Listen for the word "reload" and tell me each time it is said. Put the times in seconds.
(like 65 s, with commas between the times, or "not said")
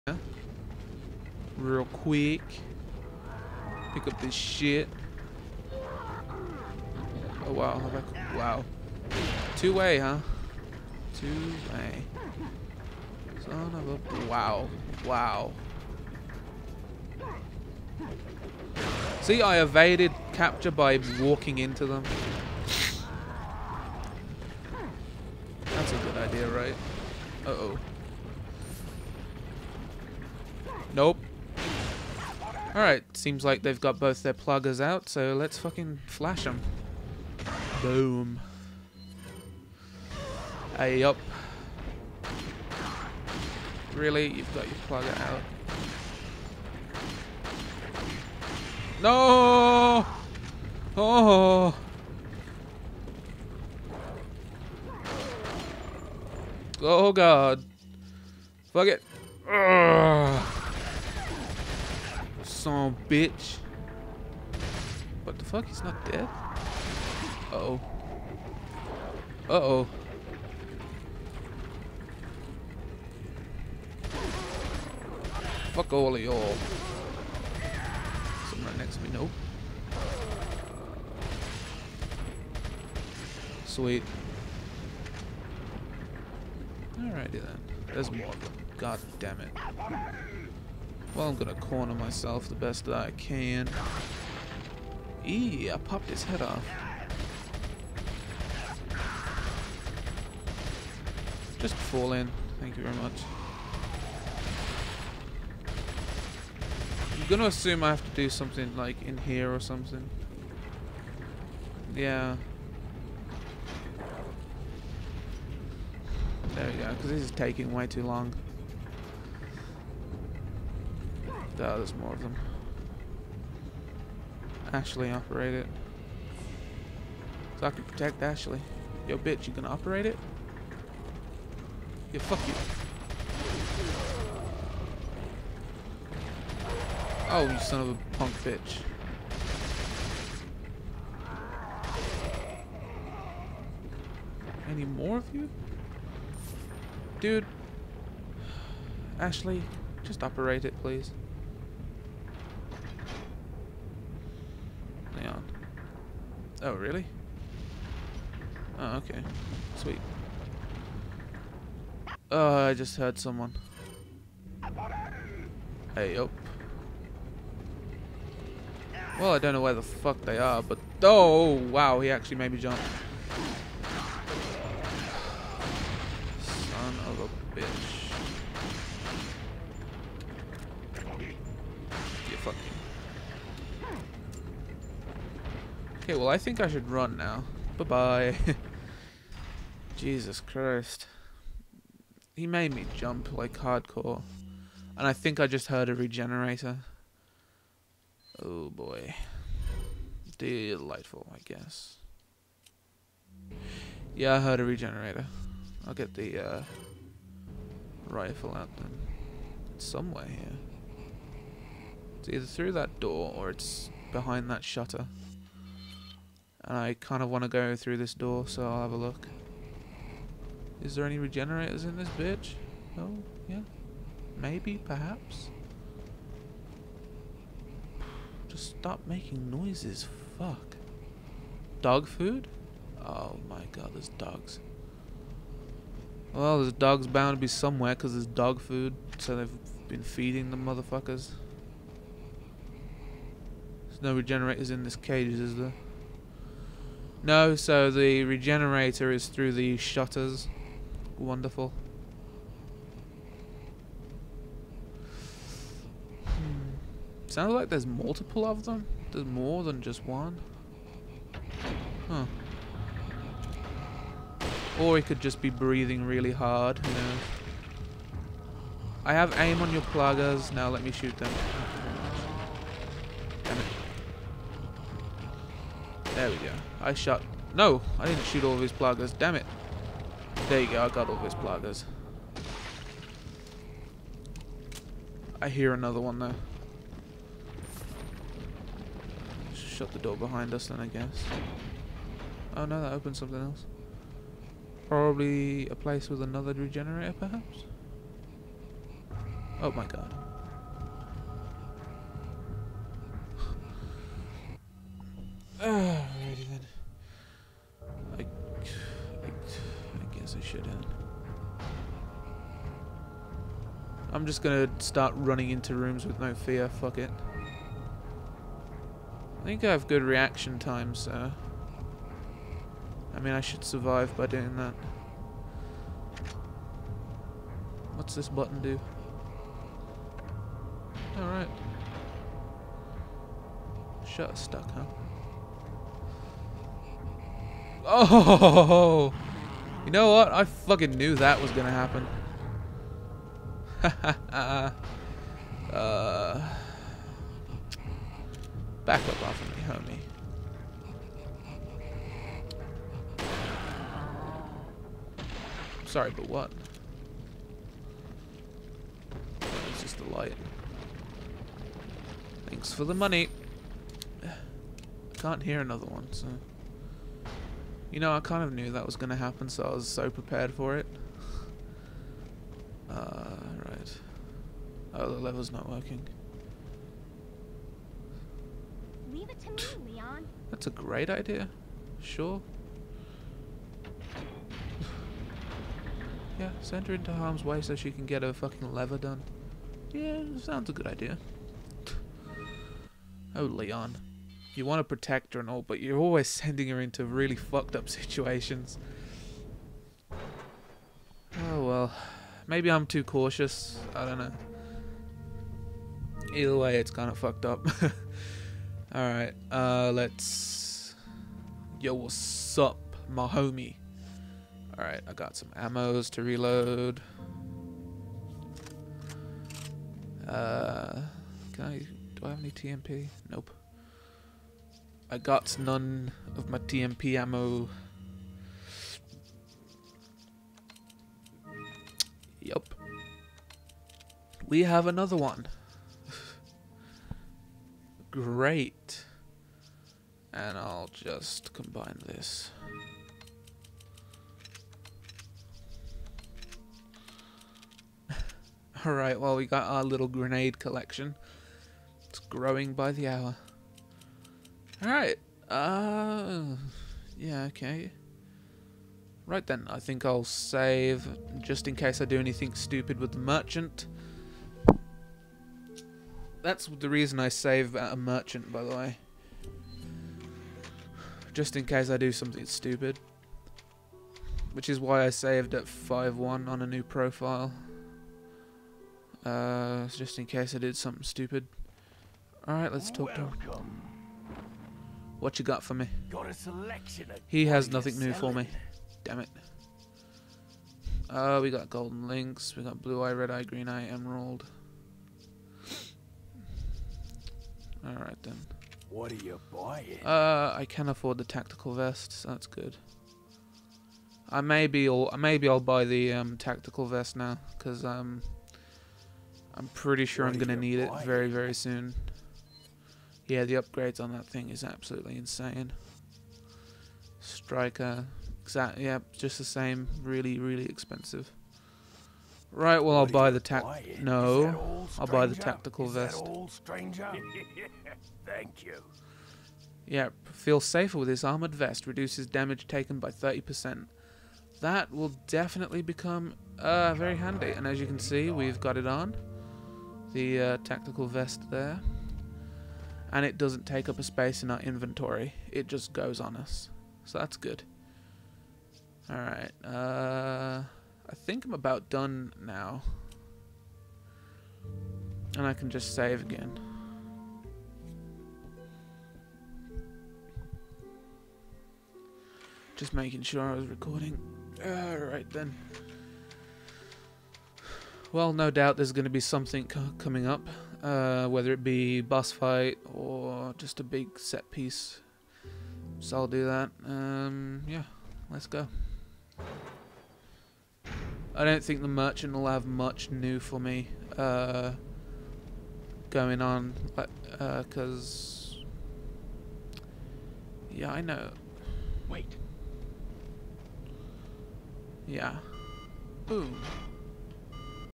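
416 s.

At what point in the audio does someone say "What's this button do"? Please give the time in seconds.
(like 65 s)
327 s.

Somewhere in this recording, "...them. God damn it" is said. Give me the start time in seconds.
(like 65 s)
88 s.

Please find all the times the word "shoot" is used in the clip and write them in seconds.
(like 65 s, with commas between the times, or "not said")
270 s, 278 s.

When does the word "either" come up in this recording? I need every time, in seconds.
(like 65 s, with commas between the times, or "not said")
212 s, 406 s.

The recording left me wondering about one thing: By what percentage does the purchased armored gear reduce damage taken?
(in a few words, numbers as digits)
30%.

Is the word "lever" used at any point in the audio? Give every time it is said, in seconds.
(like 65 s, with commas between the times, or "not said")
375 s, 388 s.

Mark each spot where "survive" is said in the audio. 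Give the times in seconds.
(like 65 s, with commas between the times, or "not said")
323 s.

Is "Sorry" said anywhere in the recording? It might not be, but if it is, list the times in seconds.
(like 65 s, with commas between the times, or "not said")
355 s.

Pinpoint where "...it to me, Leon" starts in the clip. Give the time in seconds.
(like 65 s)
379 s.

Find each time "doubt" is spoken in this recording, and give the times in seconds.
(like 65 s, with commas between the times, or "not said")
568 s.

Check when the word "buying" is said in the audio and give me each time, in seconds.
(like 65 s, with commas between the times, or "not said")
499 s, 510 s.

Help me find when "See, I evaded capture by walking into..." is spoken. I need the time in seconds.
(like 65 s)
19 s.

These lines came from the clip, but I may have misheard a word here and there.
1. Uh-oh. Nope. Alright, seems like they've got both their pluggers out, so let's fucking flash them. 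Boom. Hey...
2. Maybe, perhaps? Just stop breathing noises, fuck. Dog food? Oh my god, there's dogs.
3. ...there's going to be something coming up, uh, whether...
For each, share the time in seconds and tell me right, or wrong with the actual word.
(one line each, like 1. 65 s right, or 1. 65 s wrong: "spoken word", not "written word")
1. 27 s right
2. 224 s wrong: "making", not "breathing"
3. 568 s right.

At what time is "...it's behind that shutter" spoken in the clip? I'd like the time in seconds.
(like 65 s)
213 s.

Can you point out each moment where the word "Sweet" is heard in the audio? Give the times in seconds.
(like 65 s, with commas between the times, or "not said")
83 s, 159 s.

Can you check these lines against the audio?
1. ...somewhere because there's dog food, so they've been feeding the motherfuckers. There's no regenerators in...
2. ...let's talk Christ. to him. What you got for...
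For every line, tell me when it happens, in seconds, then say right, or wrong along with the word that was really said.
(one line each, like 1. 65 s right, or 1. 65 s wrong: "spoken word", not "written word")
1. 237 s right
2. 482 s wrong: "Welcome", not "Christ".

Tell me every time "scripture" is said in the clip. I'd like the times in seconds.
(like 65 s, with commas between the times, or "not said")
not said.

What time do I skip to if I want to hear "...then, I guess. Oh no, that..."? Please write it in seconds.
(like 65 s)
290 s.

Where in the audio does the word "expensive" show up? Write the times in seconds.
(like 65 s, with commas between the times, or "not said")
520 s.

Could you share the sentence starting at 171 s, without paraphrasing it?
Oh, wow, he actually made me jump.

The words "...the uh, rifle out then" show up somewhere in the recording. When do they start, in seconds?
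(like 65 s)
206 s.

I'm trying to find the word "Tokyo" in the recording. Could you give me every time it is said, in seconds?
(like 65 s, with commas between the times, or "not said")
not said.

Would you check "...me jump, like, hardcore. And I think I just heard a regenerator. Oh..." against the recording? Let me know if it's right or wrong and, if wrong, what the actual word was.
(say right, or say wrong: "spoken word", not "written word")
right.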